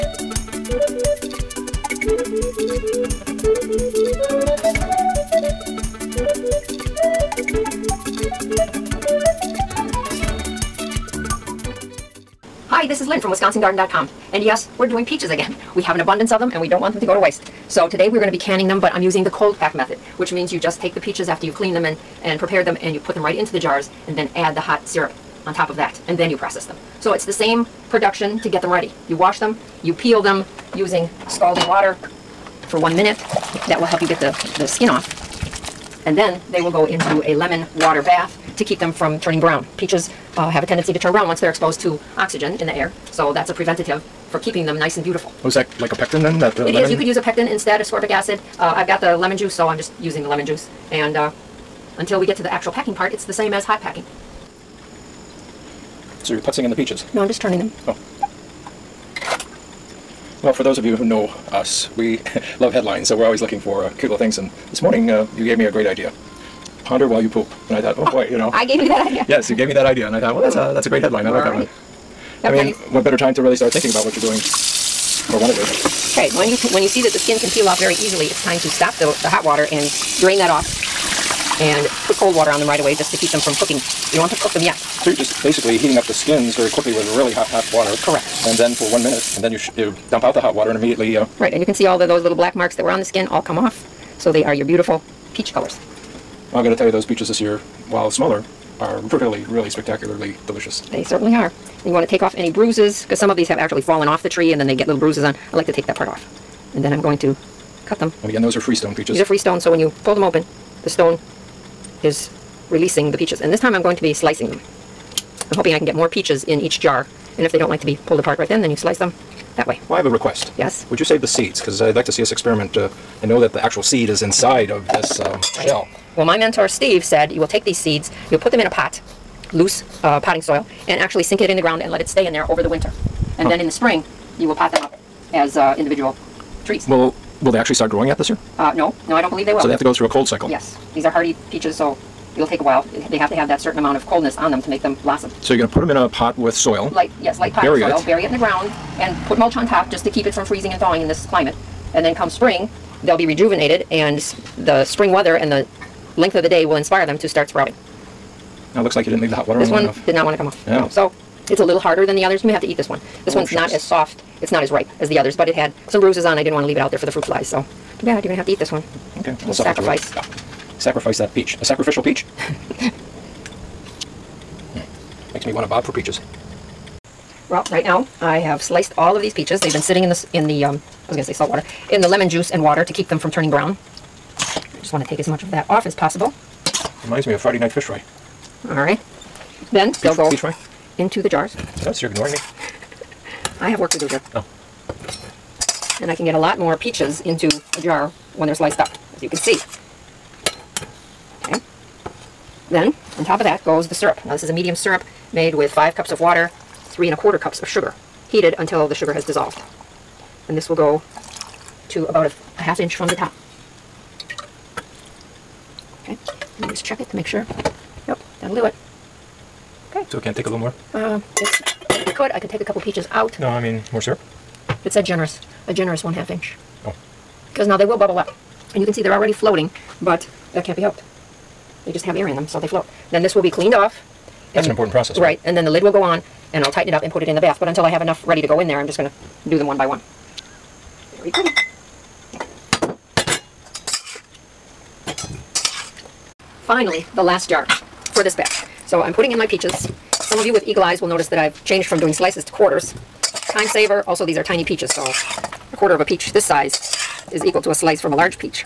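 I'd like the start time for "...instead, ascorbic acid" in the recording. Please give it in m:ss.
0:47.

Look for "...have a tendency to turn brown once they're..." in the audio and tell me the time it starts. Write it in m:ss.
0:40.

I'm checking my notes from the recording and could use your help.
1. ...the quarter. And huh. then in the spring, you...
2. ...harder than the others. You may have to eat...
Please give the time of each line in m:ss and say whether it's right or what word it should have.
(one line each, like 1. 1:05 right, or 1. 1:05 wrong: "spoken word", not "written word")
1. 2:12 wrong: "winter", not "quarter"
2. 2:41 right.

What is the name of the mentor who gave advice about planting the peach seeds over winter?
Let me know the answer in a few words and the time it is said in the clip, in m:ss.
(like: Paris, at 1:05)
Steve, at 2:06.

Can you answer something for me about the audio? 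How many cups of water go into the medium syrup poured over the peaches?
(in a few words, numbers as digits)
5 cups.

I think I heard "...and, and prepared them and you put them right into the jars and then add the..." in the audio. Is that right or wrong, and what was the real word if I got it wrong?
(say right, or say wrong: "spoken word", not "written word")
right.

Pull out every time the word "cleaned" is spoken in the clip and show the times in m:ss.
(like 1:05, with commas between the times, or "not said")
0:21, 3:53.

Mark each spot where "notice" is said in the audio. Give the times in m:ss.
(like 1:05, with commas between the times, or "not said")
3:11, 4:11.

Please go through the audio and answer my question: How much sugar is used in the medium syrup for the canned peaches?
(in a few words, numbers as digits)
3 1/4 cups.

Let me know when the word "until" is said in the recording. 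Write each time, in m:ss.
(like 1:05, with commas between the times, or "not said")
0:51, 3:28, 3:57.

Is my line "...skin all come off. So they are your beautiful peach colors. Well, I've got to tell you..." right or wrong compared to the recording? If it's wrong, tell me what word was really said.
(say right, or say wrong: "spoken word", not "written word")
right.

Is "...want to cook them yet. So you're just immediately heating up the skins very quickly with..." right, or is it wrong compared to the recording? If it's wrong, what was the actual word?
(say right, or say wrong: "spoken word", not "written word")
wrong: "basically", not "immediately".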